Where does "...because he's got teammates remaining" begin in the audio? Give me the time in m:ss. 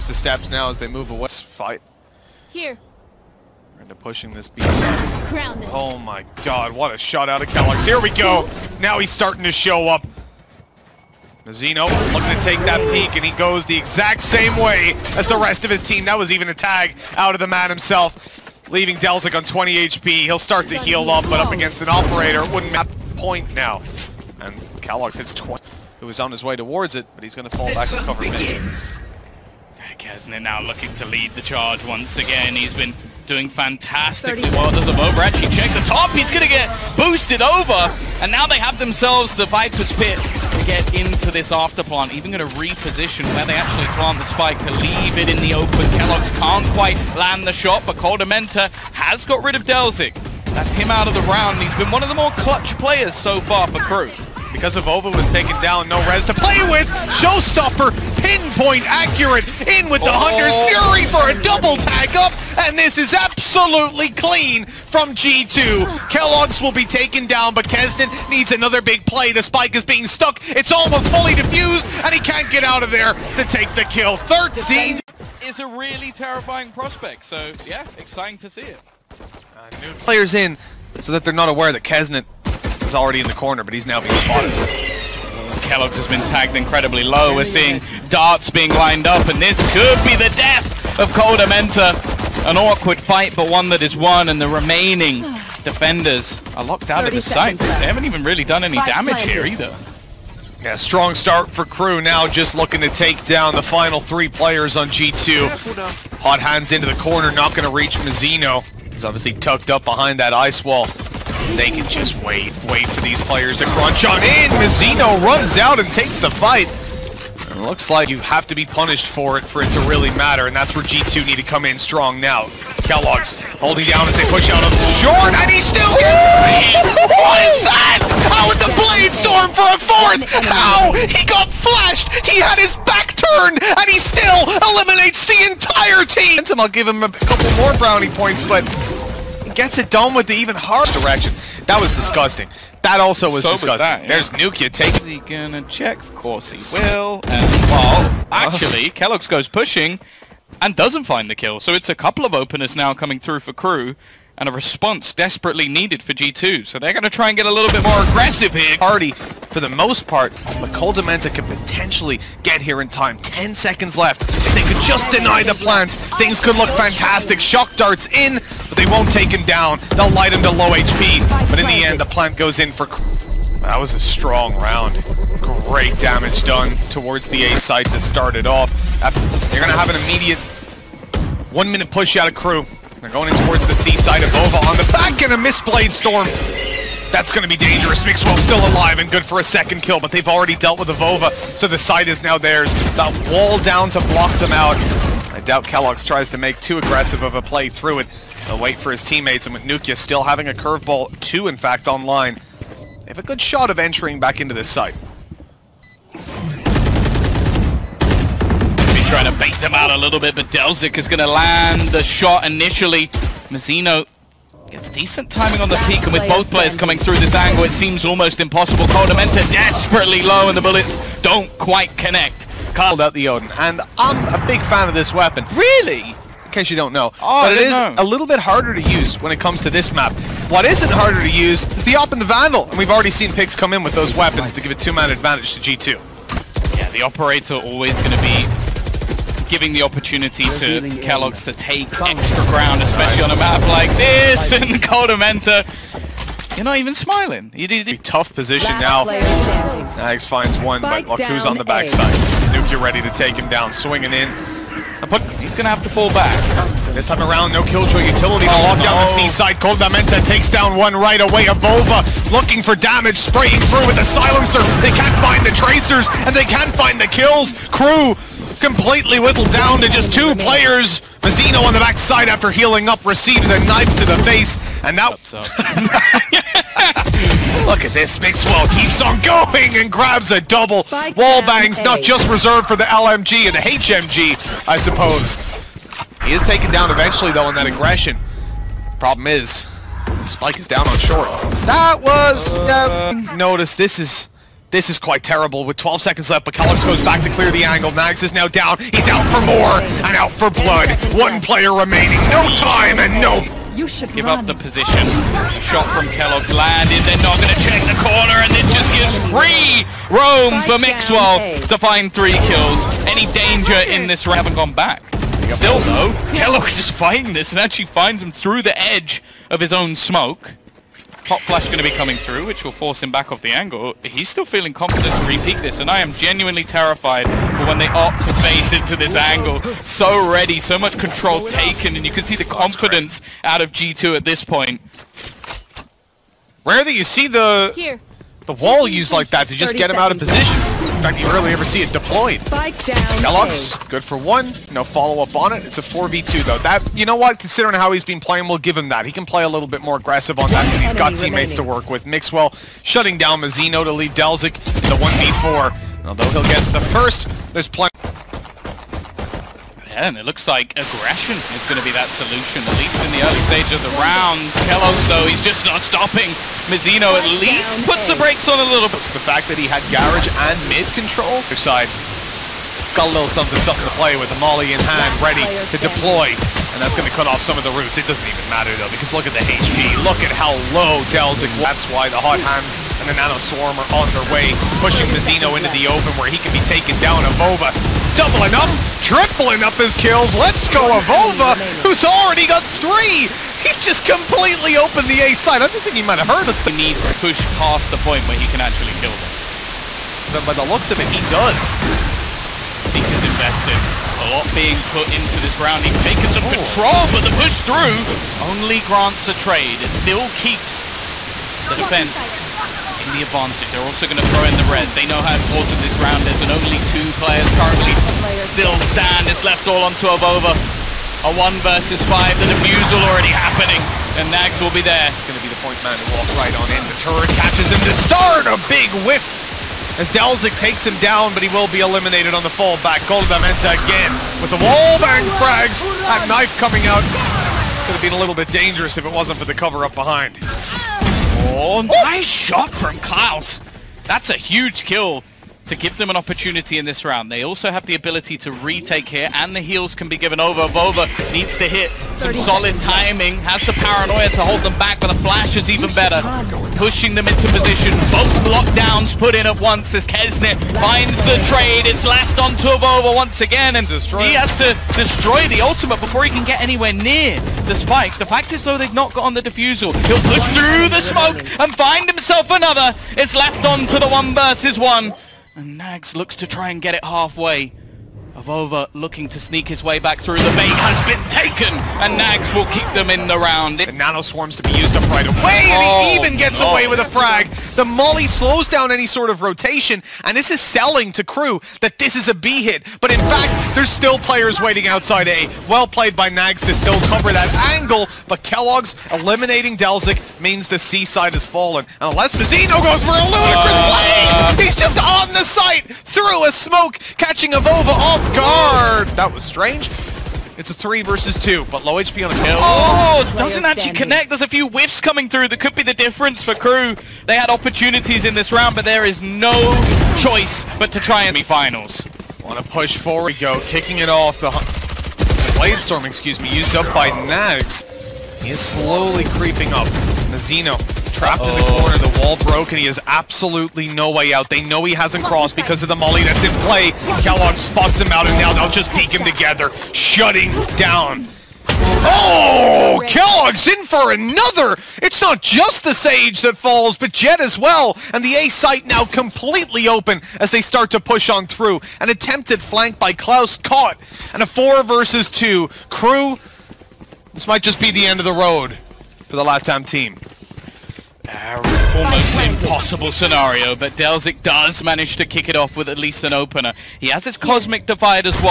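5:50.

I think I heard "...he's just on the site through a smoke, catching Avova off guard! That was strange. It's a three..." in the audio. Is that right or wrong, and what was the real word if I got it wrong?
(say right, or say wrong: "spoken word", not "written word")
right.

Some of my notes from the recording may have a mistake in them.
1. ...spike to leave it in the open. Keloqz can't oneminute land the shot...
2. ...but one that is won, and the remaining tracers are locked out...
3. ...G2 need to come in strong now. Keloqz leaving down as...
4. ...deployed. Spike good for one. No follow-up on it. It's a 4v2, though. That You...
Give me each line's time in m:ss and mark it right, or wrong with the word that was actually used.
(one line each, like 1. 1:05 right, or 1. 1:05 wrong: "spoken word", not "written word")
1. 0:44 wrong: "quite", not "oneminute"
2. 1:33 wrong: "defenders", not "tracers"
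3. 2:00 wrong: "holding", not "leaving"
4. 5:41 right.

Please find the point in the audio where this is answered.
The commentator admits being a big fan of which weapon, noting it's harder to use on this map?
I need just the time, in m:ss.
3:43.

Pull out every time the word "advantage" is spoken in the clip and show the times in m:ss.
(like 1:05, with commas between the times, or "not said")
3:55, 6:53.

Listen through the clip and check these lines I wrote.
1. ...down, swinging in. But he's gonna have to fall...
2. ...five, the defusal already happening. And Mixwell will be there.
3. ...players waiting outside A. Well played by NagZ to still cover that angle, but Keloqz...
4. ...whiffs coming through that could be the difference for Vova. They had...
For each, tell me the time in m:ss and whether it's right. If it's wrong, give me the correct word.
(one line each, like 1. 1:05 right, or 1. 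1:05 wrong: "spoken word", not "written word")
1. 4:13 right
2. 7:02 wrong: "NagZ", not "Mixwell"
3. 8:14 right
4. 8:34 wrong: "KRÜ", not "Vova".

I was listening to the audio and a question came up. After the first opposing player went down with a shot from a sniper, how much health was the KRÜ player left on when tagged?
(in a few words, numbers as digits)
20 HP.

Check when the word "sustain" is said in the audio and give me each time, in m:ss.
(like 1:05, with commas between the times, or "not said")
not said.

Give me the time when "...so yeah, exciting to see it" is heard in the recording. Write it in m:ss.
1:17.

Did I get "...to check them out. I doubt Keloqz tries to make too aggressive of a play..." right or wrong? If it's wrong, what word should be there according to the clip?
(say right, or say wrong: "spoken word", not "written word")
wrong: "block", not "check".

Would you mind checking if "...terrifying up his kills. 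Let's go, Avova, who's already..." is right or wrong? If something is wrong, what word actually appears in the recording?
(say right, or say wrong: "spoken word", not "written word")
wrong: "tripling", not "terrifying".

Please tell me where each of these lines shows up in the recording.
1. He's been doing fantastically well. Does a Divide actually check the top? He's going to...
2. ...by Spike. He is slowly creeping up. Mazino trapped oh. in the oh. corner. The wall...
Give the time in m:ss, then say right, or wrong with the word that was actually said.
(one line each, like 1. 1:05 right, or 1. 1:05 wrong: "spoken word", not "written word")
1. 0:32 wrong: "Vova", not "Divide"
2. 8:46 wrong: "NagZ", not "Spike".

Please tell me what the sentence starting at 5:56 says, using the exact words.
Although he'll get the first, there's plenty...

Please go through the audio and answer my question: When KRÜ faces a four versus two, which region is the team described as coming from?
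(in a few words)
Latam.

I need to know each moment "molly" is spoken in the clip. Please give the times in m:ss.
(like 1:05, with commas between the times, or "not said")
6:14, 8:07, 8:55.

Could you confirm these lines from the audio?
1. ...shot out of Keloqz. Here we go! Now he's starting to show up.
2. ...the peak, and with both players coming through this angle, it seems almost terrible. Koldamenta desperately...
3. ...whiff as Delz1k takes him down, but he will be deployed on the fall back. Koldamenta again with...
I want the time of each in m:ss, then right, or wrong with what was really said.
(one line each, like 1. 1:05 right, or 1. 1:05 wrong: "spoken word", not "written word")
1. 0:06 right
2. 3:35 wrong: "impossible", not "terrible"
3. 7:08 wrong: "eliminated", not "deployed".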